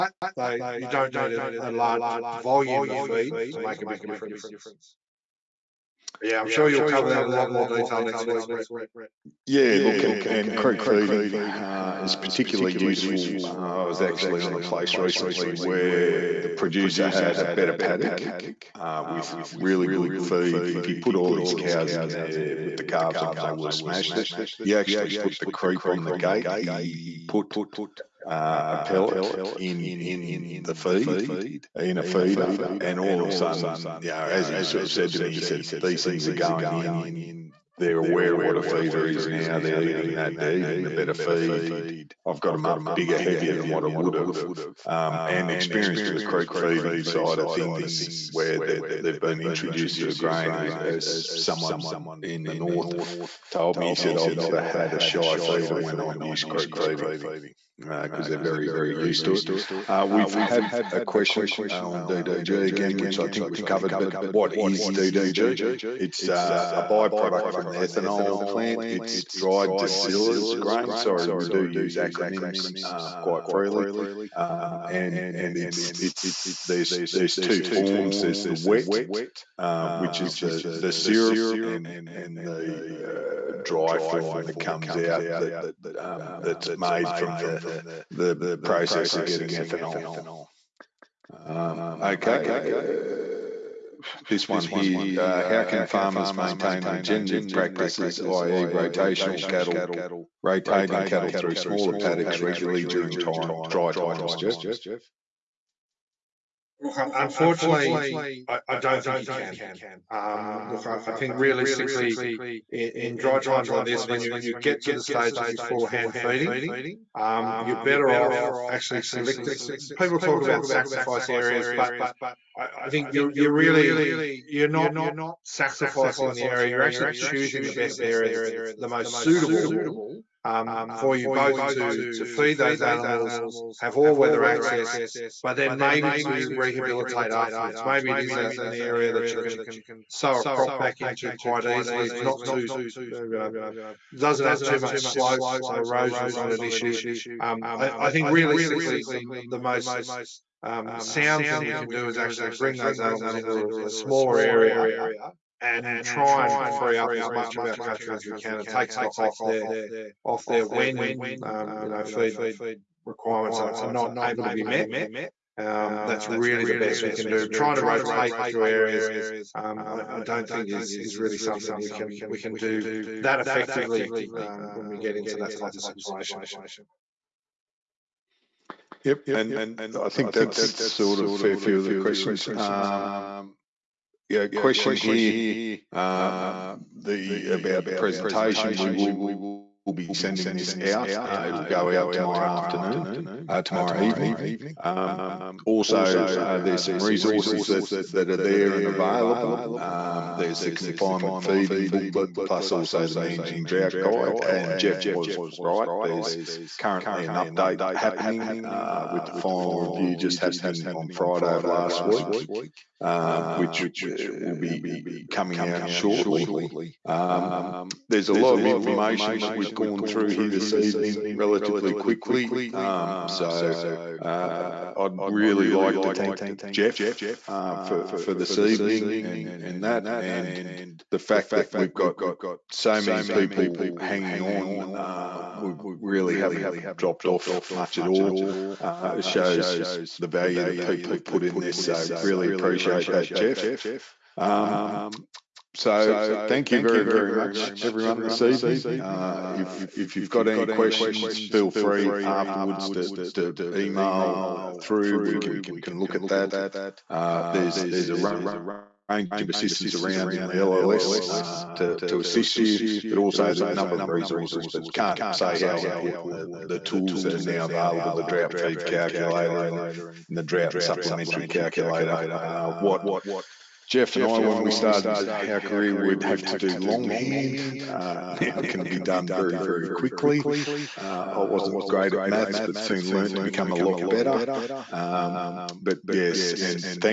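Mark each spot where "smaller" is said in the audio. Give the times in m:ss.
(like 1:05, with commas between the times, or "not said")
1:41, 2:33.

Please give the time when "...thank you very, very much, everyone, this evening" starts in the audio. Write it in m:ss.
4:06.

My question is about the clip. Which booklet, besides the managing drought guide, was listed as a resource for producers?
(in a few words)
confinement feeding booklet.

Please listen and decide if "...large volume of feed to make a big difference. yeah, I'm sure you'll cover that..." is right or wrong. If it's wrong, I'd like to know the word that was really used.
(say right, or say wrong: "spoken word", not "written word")
right.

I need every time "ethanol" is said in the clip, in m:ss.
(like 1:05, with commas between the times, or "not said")
1:07, 1:29.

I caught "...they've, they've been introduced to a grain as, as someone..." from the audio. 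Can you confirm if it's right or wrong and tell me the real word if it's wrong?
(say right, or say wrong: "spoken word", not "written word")
right.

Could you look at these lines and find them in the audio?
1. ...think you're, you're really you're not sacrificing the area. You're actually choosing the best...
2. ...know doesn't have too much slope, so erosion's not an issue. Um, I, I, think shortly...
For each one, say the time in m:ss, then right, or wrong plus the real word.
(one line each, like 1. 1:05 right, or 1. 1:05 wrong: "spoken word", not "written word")
1. 2:02 right
2. 2:23 wrong: "realistically", not "shortly".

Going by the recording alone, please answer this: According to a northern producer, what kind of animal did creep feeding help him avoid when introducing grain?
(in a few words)
shy feeder.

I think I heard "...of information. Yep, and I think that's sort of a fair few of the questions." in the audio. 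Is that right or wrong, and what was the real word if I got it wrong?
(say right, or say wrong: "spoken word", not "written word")
wrong: "situation", not "information".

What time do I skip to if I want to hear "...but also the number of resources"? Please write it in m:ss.
4:23.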